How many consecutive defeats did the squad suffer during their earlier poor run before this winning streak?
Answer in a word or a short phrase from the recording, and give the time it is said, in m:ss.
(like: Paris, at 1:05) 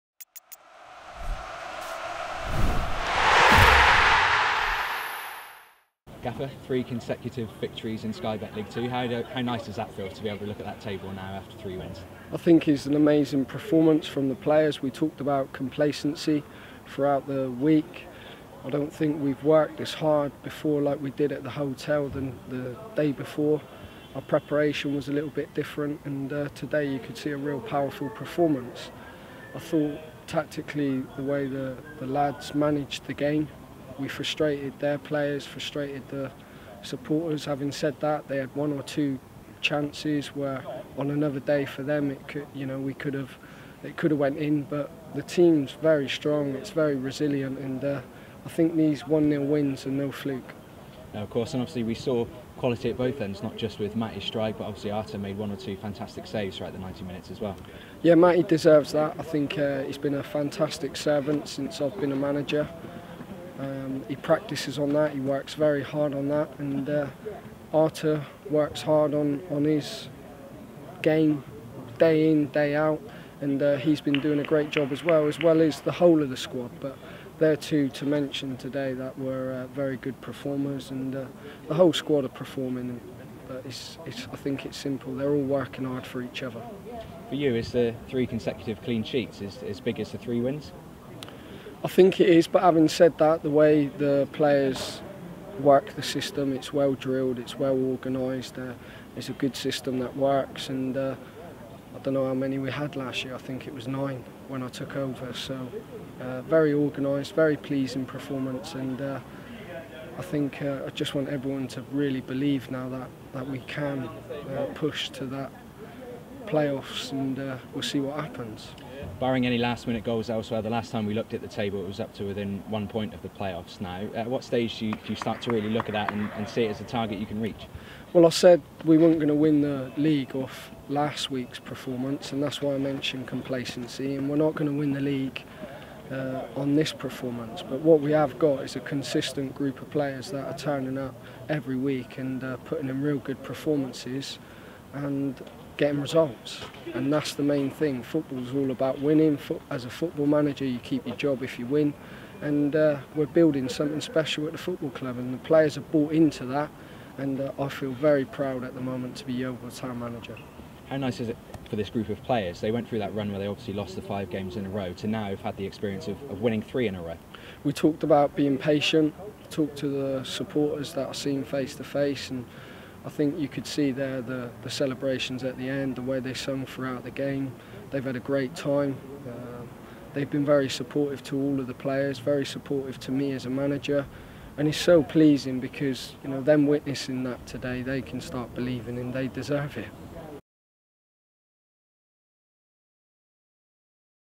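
5, at 2:44.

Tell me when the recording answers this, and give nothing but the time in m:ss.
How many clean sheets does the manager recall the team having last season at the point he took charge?
1:43.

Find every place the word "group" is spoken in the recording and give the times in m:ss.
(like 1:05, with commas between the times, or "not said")
2:19, 2:41.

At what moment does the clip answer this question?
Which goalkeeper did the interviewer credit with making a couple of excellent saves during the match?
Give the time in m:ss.
0:54.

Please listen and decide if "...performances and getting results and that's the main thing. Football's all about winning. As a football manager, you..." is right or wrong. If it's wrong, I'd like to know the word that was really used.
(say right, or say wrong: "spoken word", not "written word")
right.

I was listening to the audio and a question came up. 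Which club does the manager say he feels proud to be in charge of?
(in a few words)
Yeovil Town.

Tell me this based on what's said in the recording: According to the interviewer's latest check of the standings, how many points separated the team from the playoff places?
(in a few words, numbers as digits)
1.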